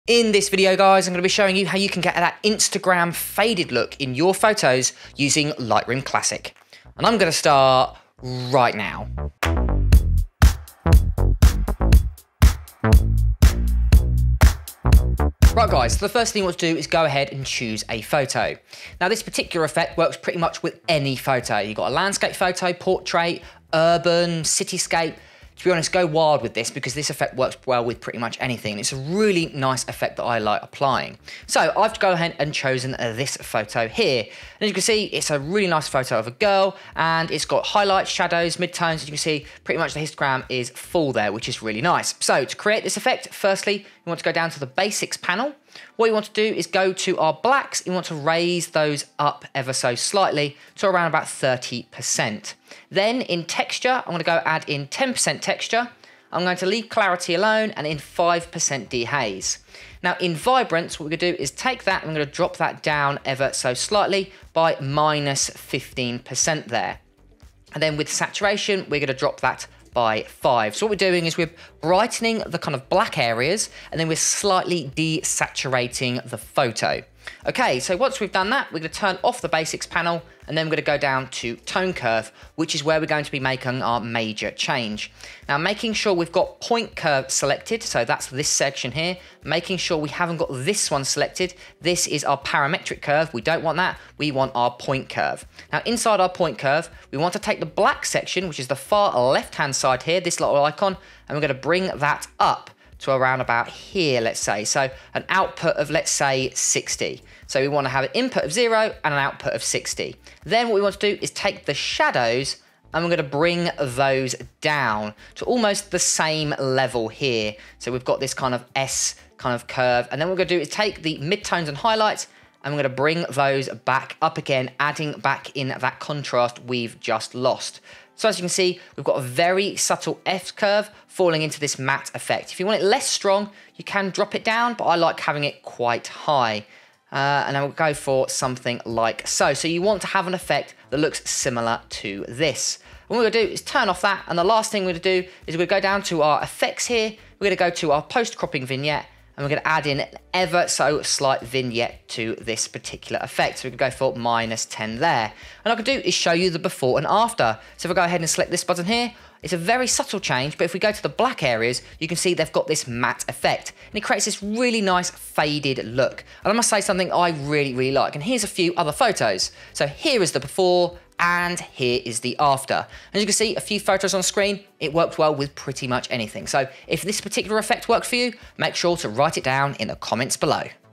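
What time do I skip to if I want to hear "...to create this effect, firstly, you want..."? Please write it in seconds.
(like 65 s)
42 s.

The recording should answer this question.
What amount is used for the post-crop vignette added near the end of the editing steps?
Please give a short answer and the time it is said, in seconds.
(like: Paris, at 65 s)
-10, at 154 s.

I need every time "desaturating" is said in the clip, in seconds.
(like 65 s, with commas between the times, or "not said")
74 s.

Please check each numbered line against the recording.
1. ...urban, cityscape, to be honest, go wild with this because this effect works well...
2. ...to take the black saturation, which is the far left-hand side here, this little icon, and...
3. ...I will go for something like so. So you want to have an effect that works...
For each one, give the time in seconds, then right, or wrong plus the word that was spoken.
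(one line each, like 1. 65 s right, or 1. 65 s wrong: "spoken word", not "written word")
1. 23 s right
2. 97 s wrong: "section", not "saturation"
3. 137 s wrong: "looks", not "works".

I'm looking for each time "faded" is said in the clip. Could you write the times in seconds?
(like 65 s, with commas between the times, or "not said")
3 s, 165 s.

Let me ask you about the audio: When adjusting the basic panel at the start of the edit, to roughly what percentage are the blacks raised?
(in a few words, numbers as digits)
30%.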